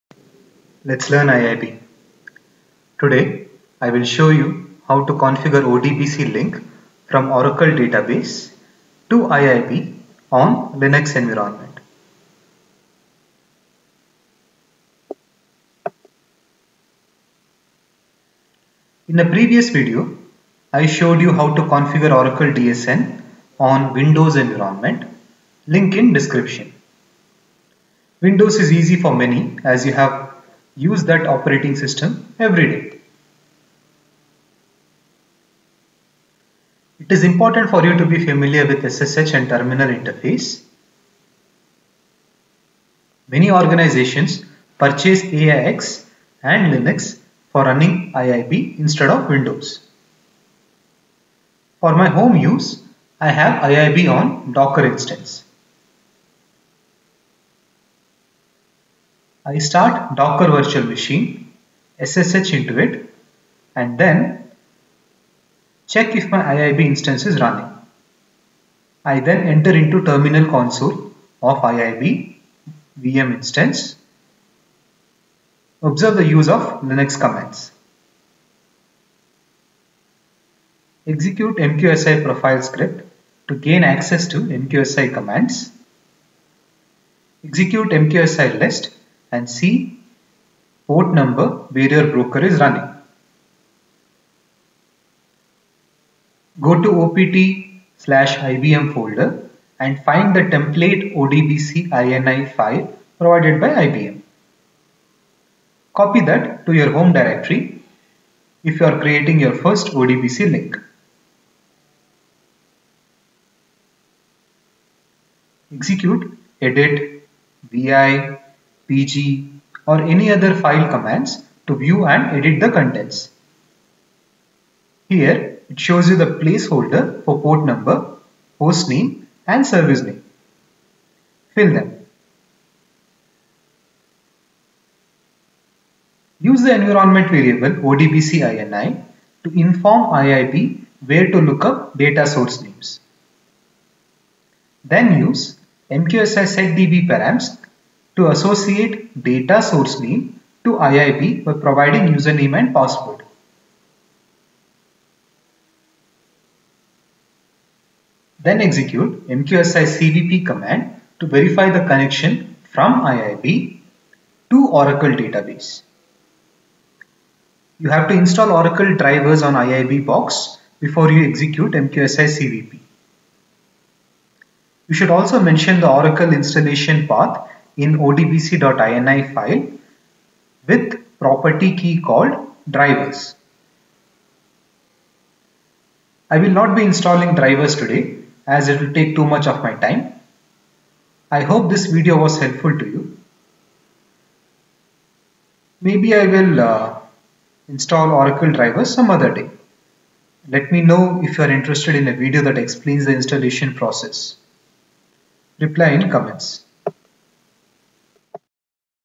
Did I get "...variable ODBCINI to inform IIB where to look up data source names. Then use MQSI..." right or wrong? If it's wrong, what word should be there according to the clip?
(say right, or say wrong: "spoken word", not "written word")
right.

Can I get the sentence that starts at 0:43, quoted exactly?
Many organizations purchase AIX and Linux for running IIB instead of Windows.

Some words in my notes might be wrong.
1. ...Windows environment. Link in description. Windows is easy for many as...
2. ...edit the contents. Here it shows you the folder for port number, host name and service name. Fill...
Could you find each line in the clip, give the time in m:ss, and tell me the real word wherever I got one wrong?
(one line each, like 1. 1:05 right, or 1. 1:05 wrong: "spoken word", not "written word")
1. 0:23 right
2. 2:02 wrong: "placeholder", not "folder".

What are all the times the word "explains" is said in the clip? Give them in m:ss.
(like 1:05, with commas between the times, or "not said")
3:22.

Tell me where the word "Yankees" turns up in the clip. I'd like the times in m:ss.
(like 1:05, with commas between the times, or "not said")
not said.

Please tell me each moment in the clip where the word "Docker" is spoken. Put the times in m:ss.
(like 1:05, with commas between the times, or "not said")
0:54, 1:00.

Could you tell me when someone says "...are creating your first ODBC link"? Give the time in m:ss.
1:48.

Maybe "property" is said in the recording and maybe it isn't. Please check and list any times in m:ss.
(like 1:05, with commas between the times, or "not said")
3:01.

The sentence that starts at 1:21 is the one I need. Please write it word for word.
Execute MQSI profile script to gain access to MQSI commands.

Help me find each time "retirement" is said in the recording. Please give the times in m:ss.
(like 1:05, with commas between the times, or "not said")
not said.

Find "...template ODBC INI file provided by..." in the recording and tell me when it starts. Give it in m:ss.
1:40.